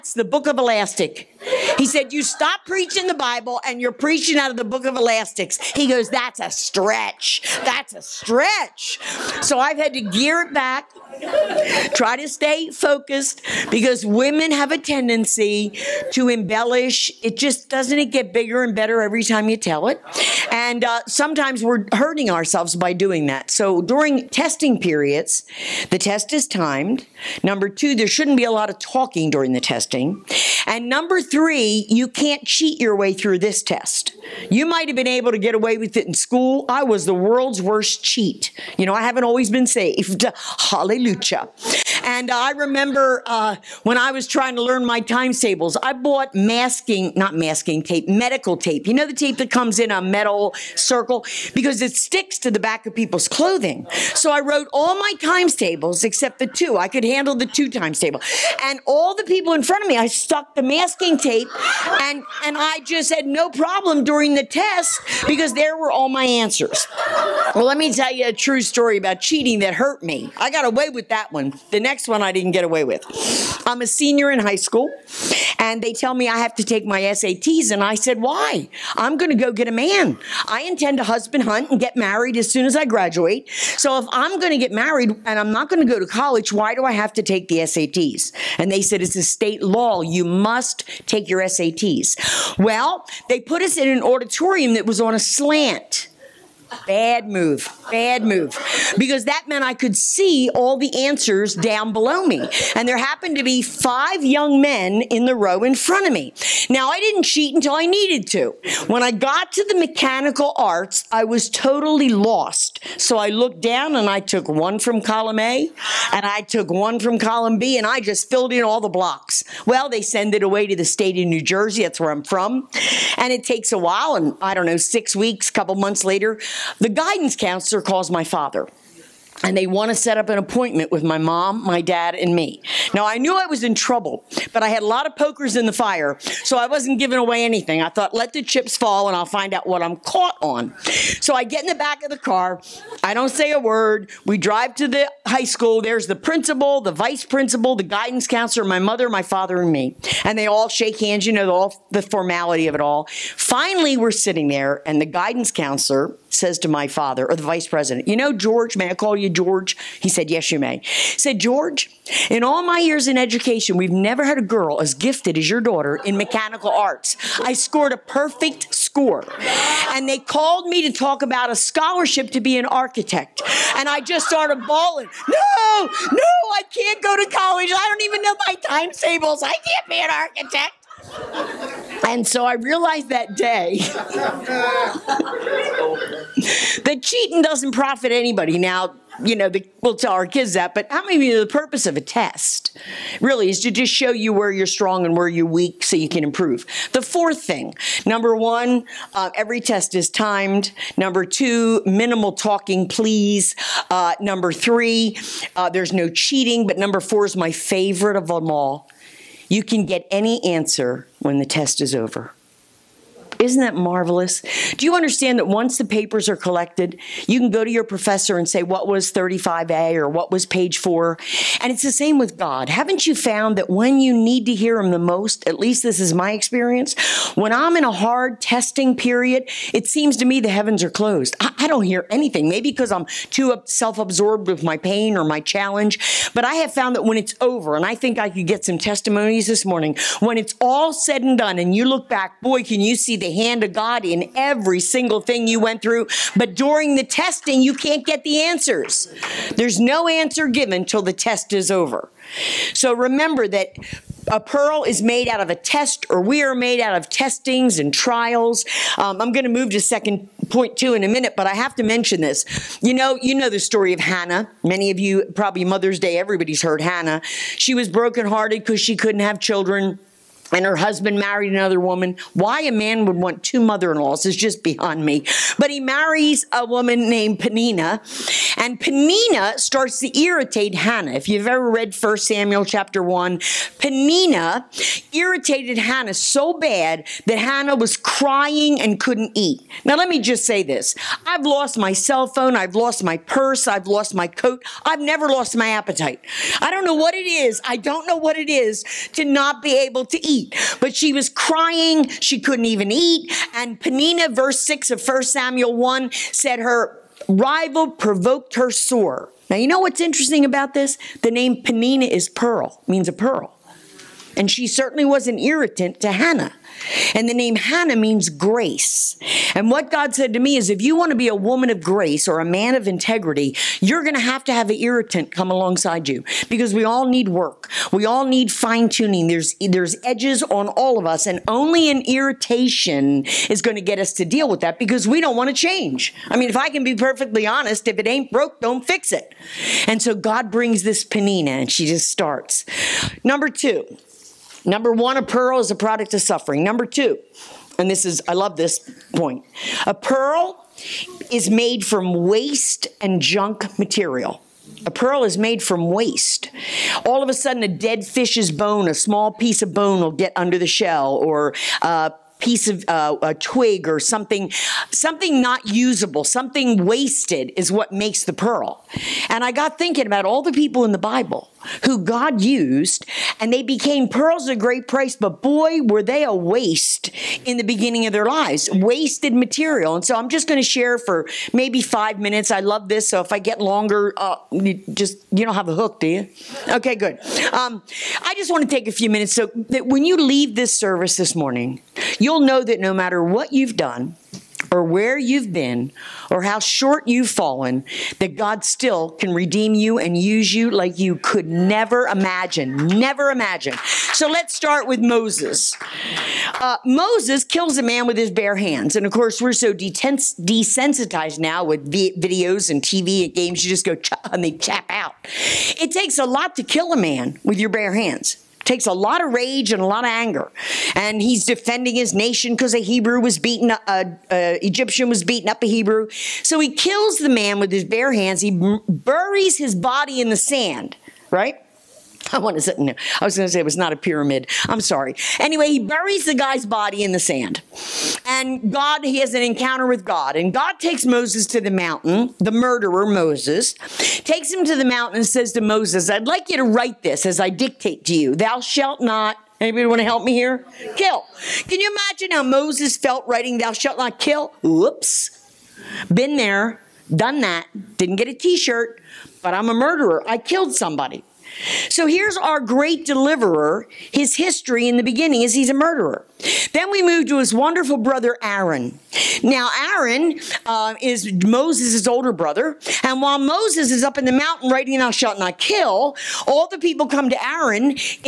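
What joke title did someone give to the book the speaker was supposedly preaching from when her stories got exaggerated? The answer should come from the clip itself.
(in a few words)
The book of elastics.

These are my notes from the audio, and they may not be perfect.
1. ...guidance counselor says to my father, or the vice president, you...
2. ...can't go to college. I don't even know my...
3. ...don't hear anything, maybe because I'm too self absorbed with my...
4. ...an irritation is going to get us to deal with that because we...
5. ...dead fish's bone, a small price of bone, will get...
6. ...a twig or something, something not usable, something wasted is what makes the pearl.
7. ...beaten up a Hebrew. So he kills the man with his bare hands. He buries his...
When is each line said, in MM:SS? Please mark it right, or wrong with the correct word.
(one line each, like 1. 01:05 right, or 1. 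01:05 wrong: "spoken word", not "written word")
1. 02:35 right
2. 02:56 right
3. 03:51 right
4. 05:31 right
5. 05:57 wrong: "piece", not "price"
6. 06:03 right
7. 07:05 right.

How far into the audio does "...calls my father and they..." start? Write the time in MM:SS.
02:07.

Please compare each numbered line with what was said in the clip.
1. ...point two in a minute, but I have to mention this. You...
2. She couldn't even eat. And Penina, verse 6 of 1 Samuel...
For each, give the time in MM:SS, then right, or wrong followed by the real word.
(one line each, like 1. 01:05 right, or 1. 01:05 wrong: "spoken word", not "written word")
1. 04:20 right
2. 05:02 right.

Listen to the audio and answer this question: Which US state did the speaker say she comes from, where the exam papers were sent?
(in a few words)
New Jersey.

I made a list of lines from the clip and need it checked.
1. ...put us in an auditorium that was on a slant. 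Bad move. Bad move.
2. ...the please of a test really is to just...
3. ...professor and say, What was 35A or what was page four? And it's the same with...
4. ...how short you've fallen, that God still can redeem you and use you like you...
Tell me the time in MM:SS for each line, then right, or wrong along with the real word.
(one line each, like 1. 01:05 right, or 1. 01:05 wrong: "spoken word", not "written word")
1. 01:33 right
2. 03:11 wrong: "purpose", not "please"
3. 03:37 right
4. 06:36 right.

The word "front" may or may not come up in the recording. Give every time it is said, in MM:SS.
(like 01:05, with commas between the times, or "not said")
00:59, 01:45.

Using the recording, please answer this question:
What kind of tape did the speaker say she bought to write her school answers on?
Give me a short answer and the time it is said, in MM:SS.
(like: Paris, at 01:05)
Medical tape, at 00:48.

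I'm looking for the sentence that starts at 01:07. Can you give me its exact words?
Well, let me tell you a true story about cheating that hurt me.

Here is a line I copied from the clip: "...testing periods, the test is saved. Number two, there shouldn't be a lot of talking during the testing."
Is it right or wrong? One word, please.
wrong.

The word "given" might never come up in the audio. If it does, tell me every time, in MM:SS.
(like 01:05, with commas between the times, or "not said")
04:10.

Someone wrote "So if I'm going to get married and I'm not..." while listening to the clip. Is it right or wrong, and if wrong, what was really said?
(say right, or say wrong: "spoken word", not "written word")
right.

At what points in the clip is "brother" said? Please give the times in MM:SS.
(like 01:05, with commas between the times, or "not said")
07:47, 07:52.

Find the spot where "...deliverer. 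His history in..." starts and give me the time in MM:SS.
07:43.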